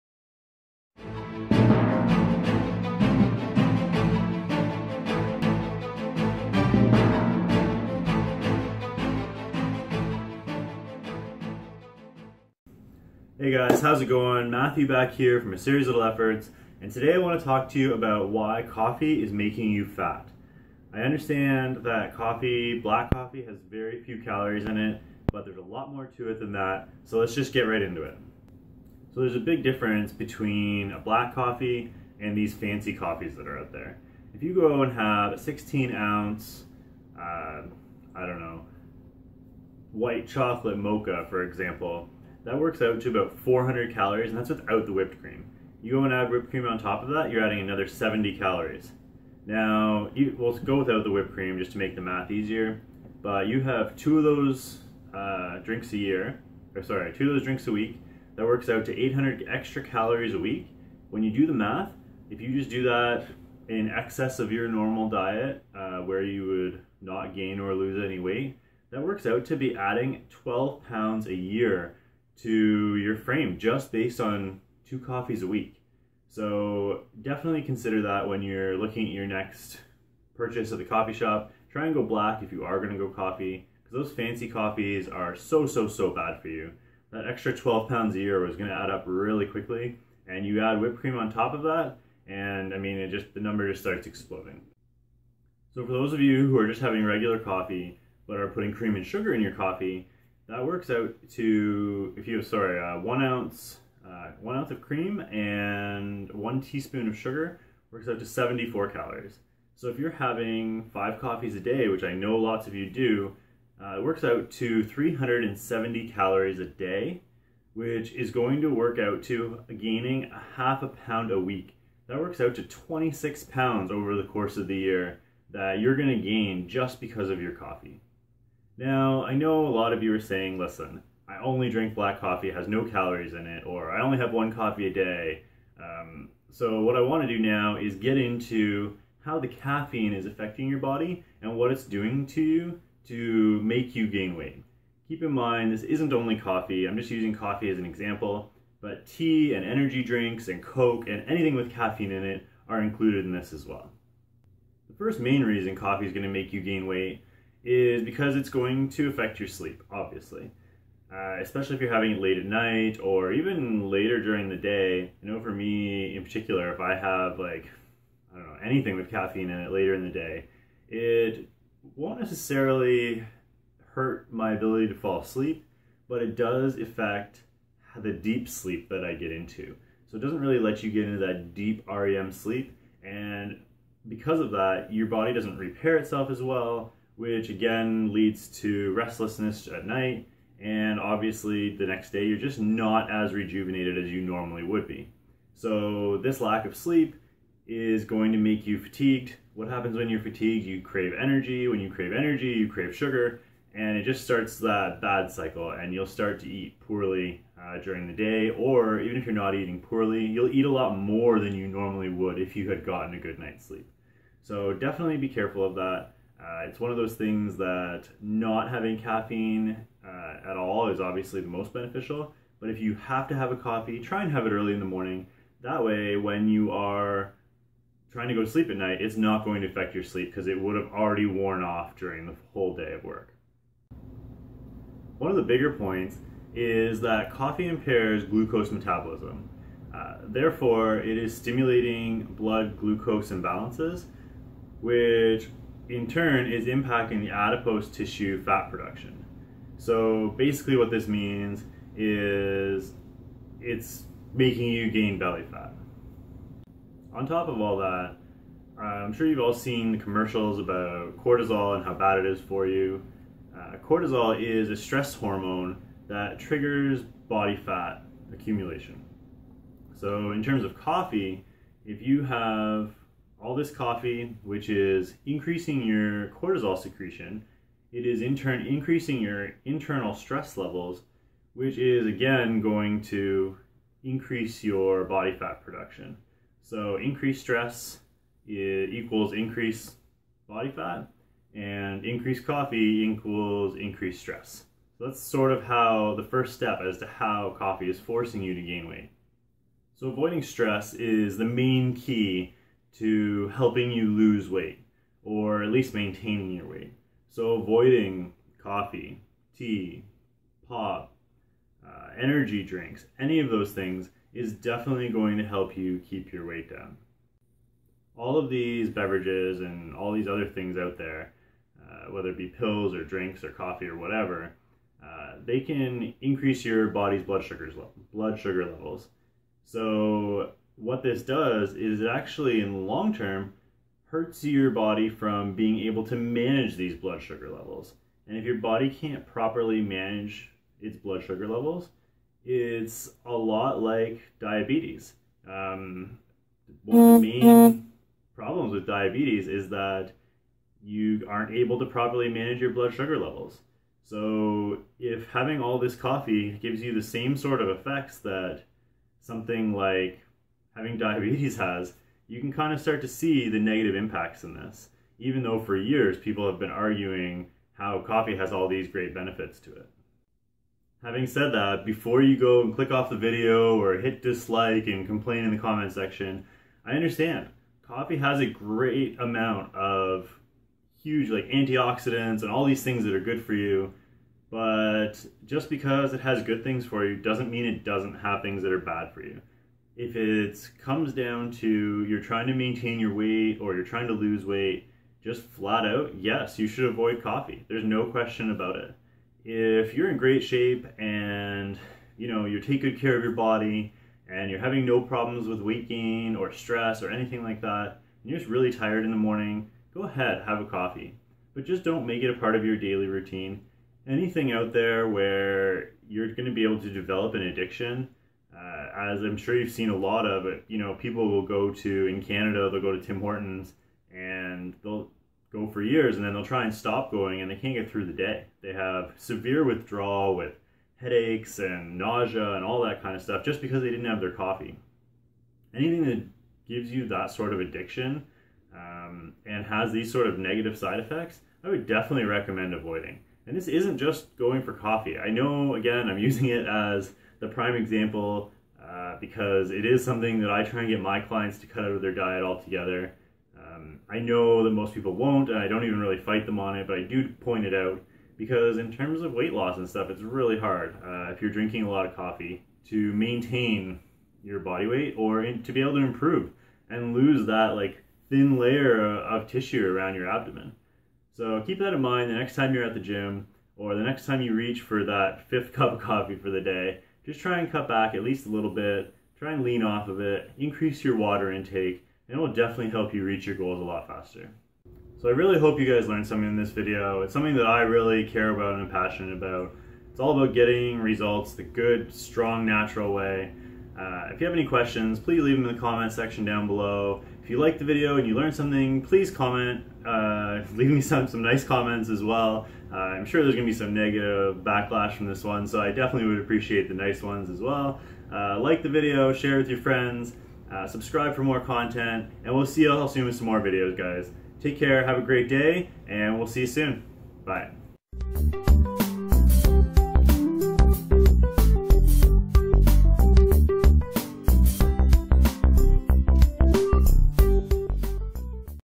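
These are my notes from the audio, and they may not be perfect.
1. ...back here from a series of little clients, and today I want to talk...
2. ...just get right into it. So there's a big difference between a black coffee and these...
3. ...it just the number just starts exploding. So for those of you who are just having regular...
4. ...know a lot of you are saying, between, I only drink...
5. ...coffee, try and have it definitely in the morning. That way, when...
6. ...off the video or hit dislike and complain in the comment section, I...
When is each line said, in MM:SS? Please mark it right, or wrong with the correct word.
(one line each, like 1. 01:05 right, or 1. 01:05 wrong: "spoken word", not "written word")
1. 00:14 wrong: "efforts", not "clients"
2. 00:27 right
3. 01:32 right
4. 02:09 wrong: "listen", not "between"
5. 03:43 wrong: "early", not "definitely"
6. 06:12 right.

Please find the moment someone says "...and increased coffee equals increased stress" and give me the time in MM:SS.
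04:51.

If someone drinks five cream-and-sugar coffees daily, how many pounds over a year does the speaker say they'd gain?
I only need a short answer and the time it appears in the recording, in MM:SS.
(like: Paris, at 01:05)
26 pounds, at 02:02.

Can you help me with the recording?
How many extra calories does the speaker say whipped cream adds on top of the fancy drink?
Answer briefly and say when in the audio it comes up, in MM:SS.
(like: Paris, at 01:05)
70, at 00:47.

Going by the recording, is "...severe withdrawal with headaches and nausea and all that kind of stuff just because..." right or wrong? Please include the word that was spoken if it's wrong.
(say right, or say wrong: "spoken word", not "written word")
right.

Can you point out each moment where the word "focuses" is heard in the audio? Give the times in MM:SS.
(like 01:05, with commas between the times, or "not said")
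not said.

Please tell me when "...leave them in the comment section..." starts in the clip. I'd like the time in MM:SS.
08:15.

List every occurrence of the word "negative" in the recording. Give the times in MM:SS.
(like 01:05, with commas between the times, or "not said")
06:03, 07:20, 08:23.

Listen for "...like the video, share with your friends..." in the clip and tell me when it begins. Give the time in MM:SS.
08:28.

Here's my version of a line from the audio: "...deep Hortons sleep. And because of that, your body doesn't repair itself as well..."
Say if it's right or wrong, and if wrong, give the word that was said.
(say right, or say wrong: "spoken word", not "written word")
wrong: "REM", not "Hortons".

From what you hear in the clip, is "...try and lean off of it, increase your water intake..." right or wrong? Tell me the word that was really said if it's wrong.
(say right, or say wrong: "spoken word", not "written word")
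right.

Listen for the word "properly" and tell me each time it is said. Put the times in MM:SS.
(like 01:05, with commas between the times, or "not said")
05:39, 05:51.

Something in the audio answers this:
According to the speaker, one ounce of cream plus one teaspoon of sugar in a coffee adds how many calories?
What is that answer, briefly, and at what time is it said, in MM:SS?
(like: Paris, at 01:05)
74, at 01:48.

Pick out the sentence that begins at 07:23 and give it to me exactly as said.
And this isn't just going for coffee.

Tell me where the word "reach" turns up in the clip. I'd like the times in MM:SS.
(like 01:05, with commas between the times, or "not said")
07:54, 08:03.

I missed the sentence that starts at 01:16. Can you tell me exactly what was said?
So definitely consider that when you're looking at your next purchase at the coffee shop.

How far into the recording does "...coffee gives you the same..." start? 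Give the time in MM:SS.
05:55.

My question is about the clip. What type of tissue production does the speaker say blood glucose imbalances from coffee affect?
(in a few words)
Adipose tissue.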